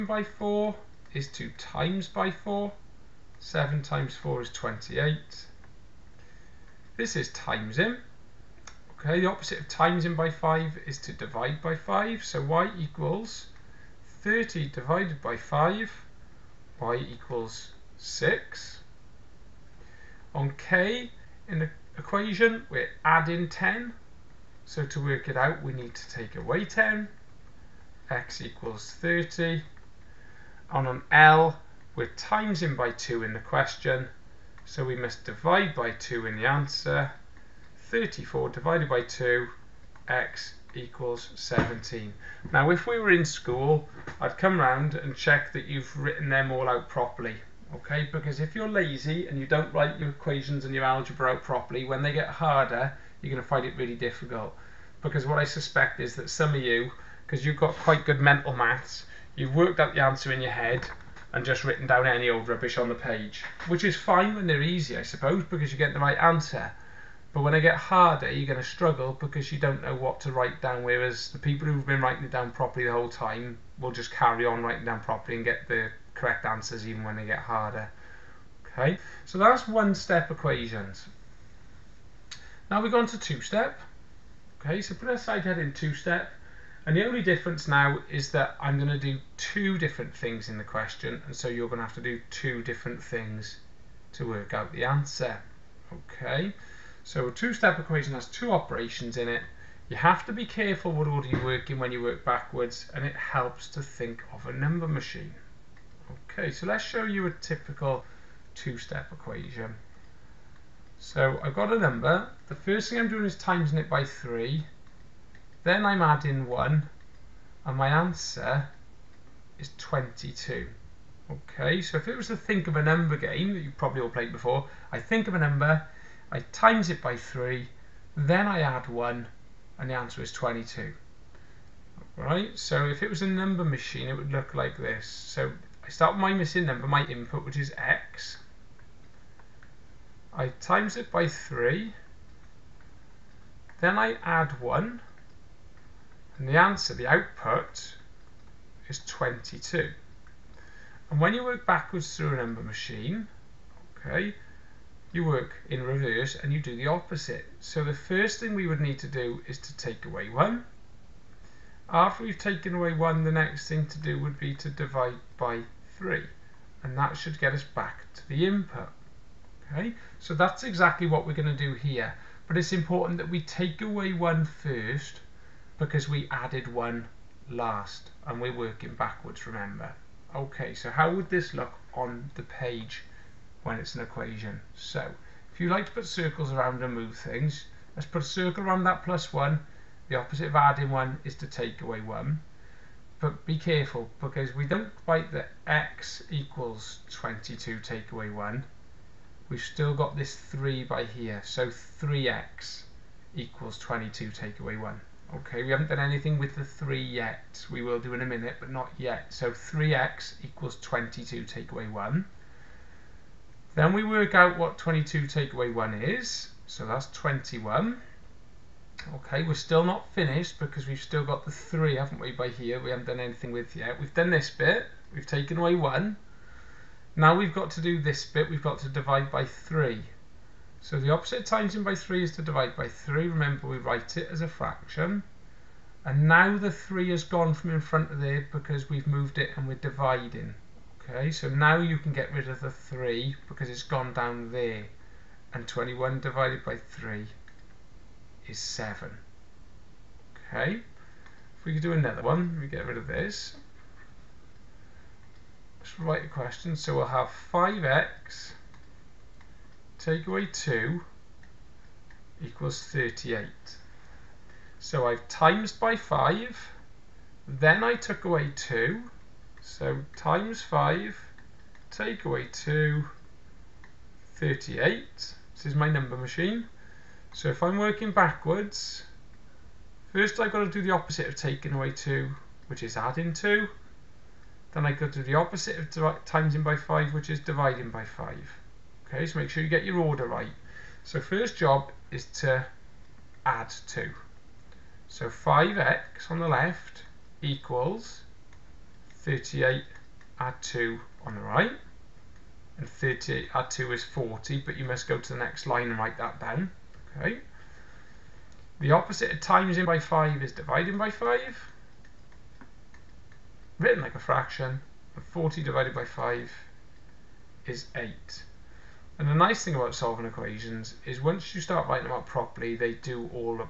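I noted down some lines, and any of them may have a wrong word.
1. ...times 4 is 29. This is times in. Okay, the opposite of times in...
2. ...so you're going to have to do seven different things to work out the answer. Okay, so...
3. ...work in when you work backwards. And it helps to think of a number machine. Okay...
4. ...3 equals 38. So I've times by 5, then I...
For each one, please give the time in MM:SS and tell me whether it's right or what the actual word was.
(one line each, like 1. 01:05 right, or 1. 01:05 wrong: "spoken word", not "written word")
1. 00:03 wrong: "28", not "29"
2. 01:31 wrong: "two", not "seven"
3. 01:41 right
4. 04:20 wrong: "2", not "3".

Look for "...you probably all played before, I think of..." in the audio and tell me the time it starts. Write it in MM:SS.
02:03.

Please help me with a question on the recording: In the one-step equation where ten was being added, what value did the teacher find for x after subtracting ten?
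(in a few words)
30.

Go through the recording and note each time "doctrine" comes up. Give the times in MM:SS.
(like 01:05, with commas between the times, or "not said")
not said.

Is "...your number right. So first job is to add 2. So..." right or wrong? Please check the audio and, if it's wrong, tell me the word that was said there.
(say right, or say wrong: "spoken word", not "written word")
wrong: "order", not "number".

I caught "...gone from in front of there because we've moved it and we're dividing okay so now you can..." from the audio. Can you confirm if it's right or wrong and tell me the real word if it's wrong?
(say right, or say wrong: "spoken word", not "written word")
right.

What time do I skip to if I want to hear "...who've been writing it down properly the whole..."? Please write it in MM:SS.
01:11.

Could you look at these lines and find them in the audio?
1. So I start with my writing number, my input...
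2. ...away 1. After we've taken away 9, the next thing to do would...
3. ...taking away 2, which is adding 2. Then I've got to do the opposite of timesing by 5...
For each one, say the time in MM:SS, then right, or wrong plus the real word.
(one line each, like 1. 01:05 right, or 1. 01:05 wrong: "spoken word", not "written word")
1. 02:15 wrong: "missing", not "writing"
2. 02:40 wrong: "1", not "9"
3. 04:41 right.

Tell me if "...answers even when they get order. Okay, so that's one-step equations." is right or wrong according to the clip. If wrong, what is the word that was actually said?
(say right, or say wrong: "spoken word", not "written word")
wrong: "harder", not "order".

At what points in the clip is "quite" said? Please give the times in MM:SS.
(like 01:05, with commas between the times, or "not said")
00:57.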